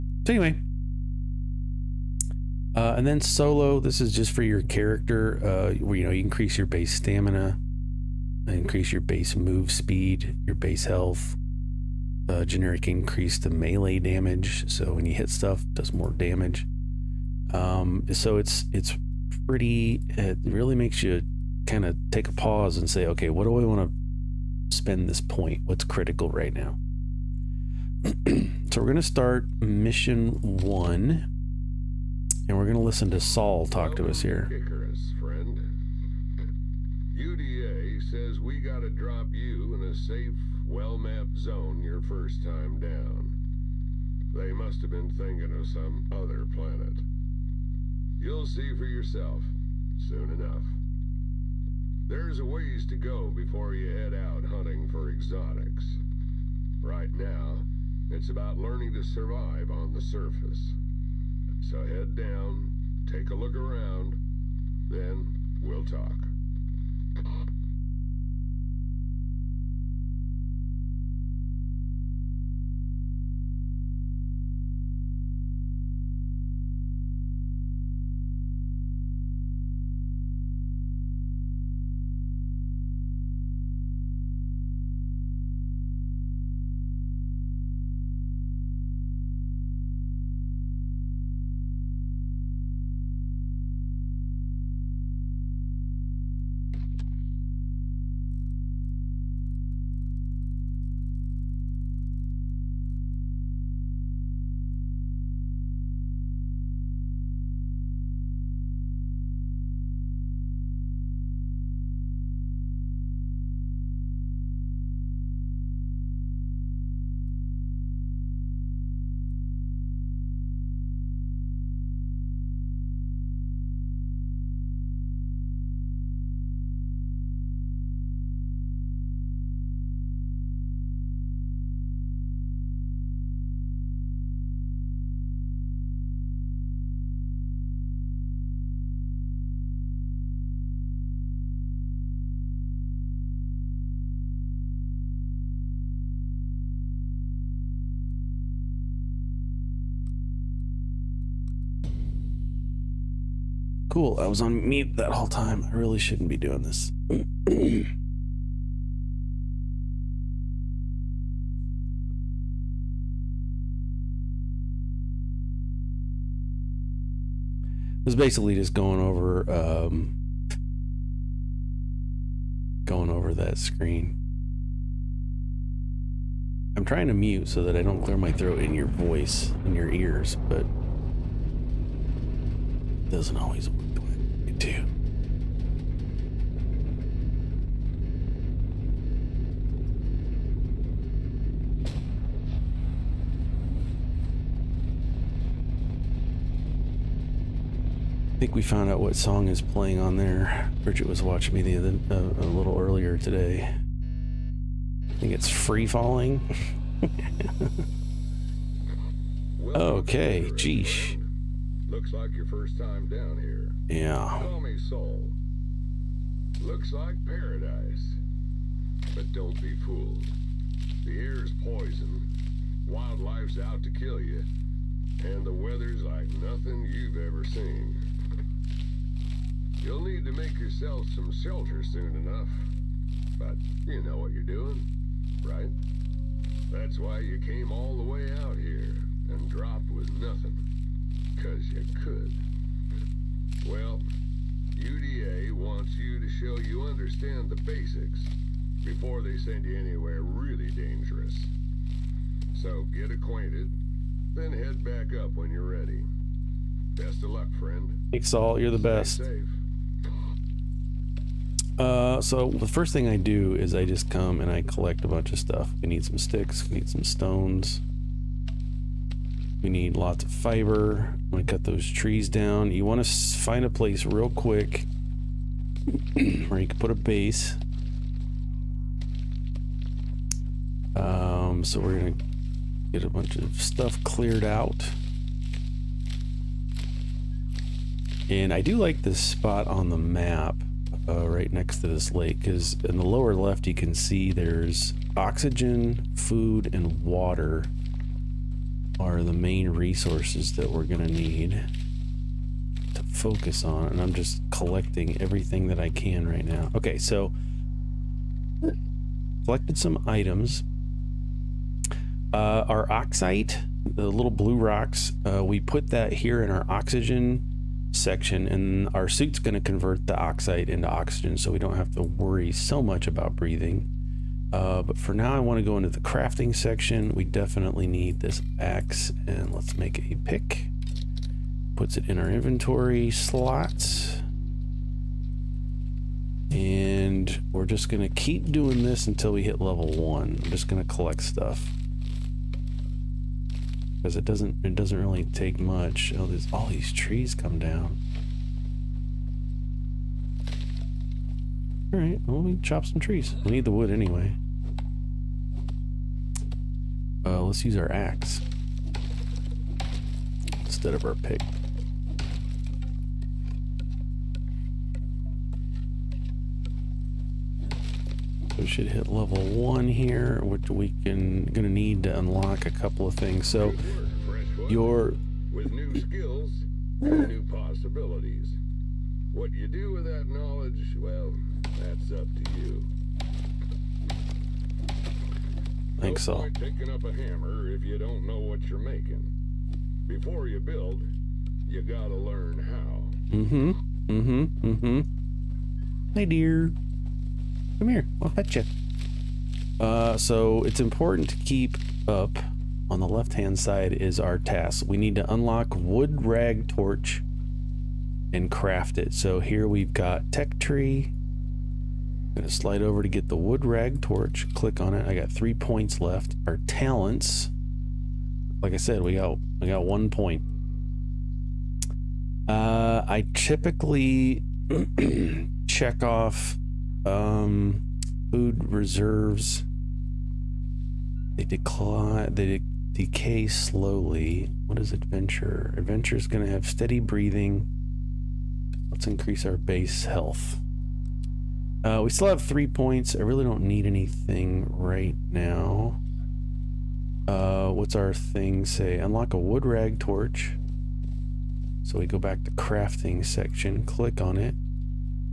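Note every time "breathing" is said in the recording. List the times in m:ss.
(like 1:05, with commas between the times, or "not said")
5:23, 7:16.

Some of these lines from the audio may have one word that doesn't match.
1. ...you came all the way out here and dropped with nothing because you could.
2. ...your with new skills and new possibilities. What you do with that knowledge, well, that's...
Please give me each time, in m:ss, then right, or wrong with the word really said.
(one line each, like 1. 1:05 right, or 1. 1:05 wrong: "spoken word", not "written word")
1. 3:57 right
2. 6:14 right.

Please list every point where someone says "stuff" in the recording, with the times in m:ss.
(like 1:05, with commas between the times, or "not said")
0:15, 4:25, 4:43, 5:41.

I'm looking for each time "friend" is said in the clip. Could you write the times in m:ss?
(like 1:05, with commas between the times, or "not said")
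0:35, 4:17.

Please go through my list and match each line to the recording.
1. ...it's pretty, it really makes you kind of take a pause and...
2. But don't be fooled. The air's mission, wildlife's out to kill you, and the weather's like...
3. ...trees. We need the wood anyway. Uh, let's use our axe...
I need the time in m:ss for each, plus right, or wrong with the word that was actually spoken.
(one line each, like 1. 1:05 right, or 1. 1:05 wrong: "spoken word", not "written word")
1. 0:18 right
2. 3:39 wrong: "poison", not "mission"
3. 5:52 right.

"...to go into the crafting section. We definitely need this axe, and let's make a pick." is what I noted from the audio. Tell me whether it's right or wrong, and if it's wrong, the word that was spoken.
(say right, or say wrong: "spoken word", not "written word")
right.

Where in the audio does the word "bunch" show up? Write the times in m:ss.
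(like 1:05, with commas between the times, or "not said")
4:25, 4:43.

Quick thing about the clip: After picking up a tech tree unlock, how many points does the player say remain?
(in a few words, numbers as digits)
3.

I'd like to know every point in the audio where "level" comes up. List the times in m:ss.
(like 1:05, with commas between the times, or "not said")
5:39, 6:09.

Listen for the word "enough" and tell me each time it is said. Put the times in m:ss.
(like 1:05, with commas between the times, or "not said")
0:50, 3:52.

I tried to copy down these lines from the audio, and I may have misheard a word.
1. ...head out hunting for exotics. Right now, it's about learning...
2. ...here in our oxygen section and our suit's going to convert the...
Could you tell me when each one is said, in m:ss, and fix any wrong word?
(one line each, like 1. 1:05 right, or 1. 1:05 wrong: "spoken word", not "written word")
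1. 0:53 right
2. 5:16 right.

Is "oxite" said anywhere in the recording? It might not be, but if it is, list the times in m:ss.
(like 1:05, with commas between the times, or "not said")
5:12, 5:20.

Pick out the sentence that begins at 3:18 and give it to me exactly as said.
I think we found out what song is playing on there.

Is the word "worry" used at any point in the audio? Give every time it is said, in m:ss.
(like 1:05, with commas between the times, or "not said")
5:22.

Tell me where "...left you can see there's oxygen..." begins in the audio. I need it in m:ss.
4:53.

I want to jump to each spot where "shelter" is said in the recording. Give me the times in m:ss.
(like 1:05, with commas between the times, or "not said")
3:51.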